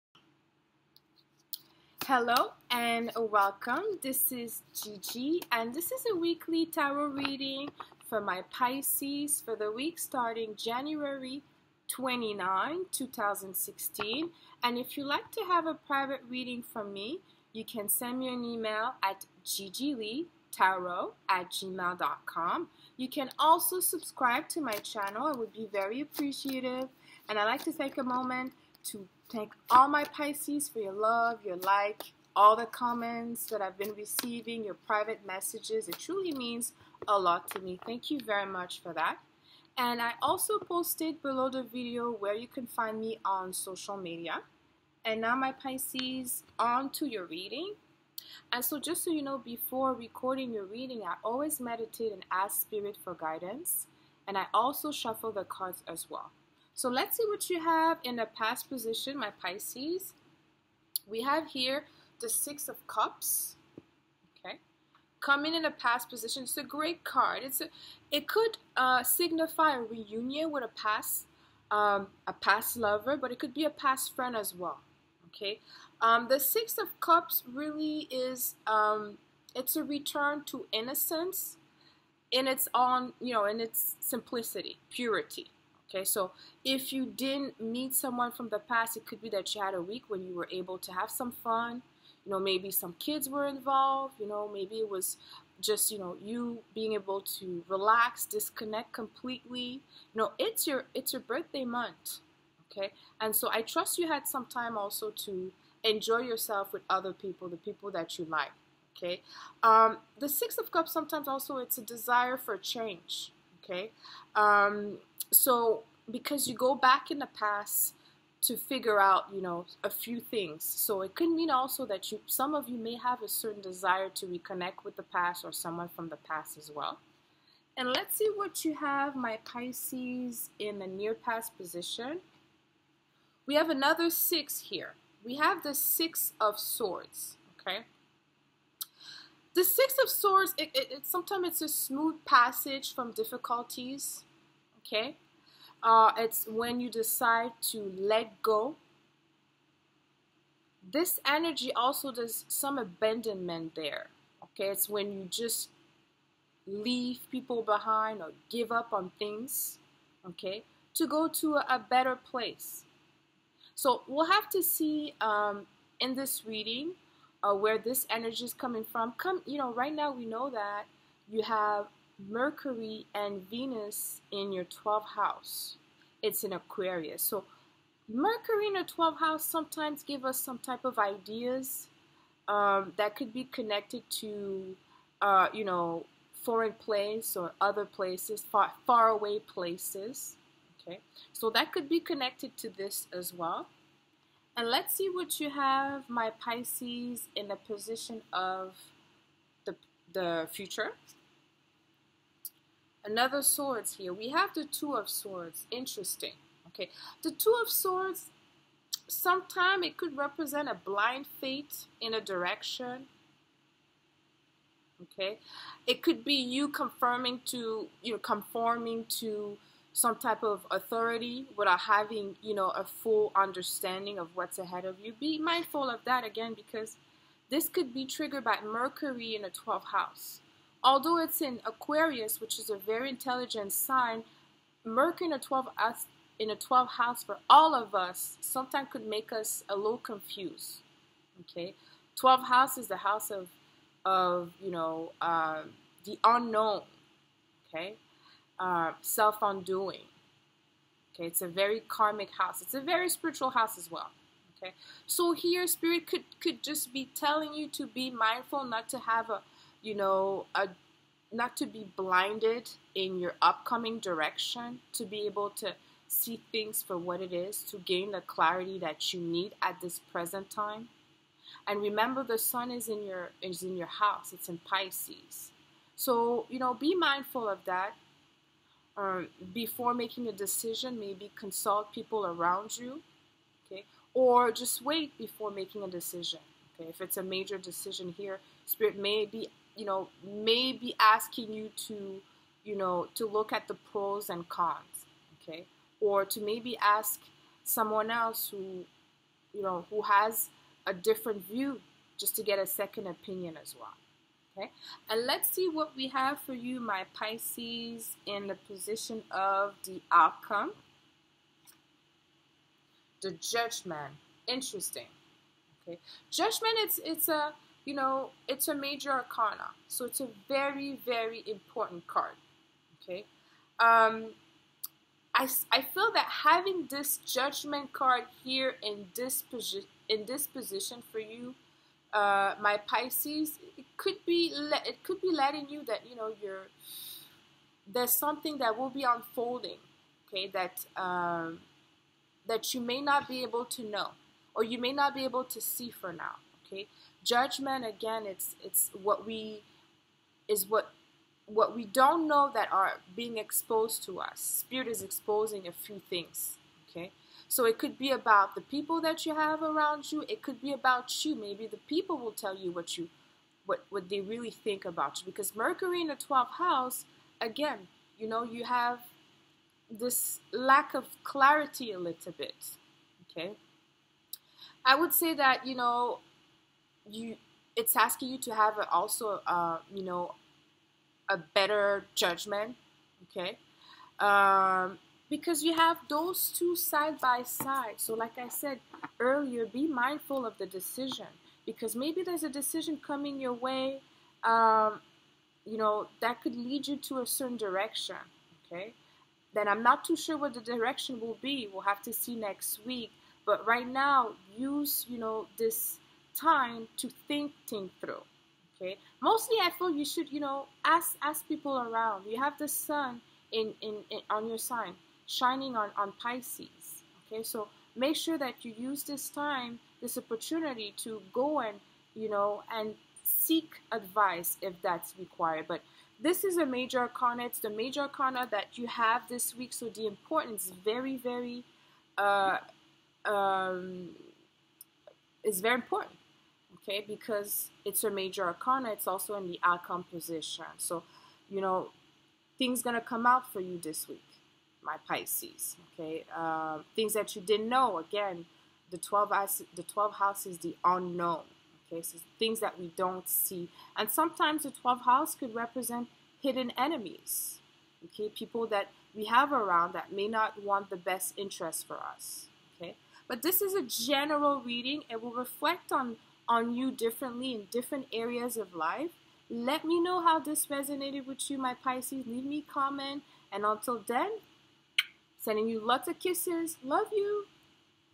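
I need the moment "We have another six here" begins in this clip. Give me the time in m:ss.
2:13.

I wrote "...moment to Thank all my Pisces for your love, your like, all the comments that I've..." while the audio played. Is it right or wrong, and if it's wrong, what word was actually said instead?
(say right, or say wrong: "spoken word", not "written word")
right.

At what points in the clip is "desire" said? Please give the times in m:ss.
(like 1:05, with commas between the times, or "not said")
1:51, 2:03.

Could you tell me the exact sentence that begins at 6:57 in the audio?
Okay, so make sure that you use this time, this opportunity to go and, you know, and seek advice if that's required.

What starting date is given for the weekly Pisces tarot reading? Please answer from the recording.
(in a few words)
January 29, 2016.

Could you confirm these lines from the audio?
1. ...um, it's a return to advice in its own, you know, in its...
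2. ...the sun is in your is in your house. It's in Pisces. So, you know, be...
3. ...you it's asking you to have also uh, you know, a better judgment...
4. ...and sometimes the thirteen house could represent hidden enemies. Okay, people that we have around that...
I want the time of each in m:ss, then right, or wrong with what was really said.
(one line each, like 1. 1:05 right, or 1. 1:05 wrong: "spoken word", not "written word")
1. 1:18 wrong: "innocence", not "advice"
2. 4:32 right
3. 6:17 right
4. 7:33 wrong: "twelve", not "thirteen".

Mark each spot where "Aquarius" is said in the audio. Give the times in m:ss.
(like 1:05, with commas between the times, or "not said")
2:56, 3:51.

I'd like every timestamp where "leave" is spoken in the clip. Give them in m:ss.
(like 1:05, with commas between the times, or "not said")
2:36, 7:52.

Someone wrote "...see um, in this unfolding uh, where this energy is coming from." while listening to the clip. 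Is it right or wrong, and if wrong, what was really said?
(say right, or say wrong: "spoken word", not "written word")
wrong: "reading", not "unfolding".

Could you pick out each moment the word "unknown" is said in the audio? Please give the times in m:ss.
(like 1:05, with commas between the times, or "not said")
4:06, 7:30.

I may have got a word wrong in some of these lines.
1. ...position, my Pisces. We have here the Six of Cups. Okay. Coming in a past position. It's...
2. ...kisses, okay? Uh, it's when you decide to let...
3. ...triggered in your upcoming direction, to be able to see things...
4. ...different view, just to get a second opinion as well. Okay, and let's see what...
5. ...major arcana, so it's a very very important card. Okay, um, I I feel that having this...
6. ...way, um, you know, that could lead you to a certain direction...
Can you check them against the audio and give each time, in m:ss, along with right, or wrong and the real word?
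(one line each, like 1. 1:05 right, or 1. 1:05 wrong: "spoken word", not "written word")
1. 0:58 right
2. 2:23 wrong: "difficulties", not "kisses"
3. 4:21 wrong: "blinded", not "triggered"
4. 5:00 right
5. 5:18 right
6. 6:33 right.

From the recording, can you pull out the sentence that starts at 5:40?
That um, that you may not be able to know, or you may not be able to see for now, okay?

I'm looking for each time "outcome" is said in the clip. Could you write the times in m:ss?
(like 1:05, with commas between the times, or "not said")
5:10, 7:19.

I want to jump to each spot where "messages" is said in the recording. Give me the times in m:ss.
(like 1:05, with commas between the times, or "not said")
0:35.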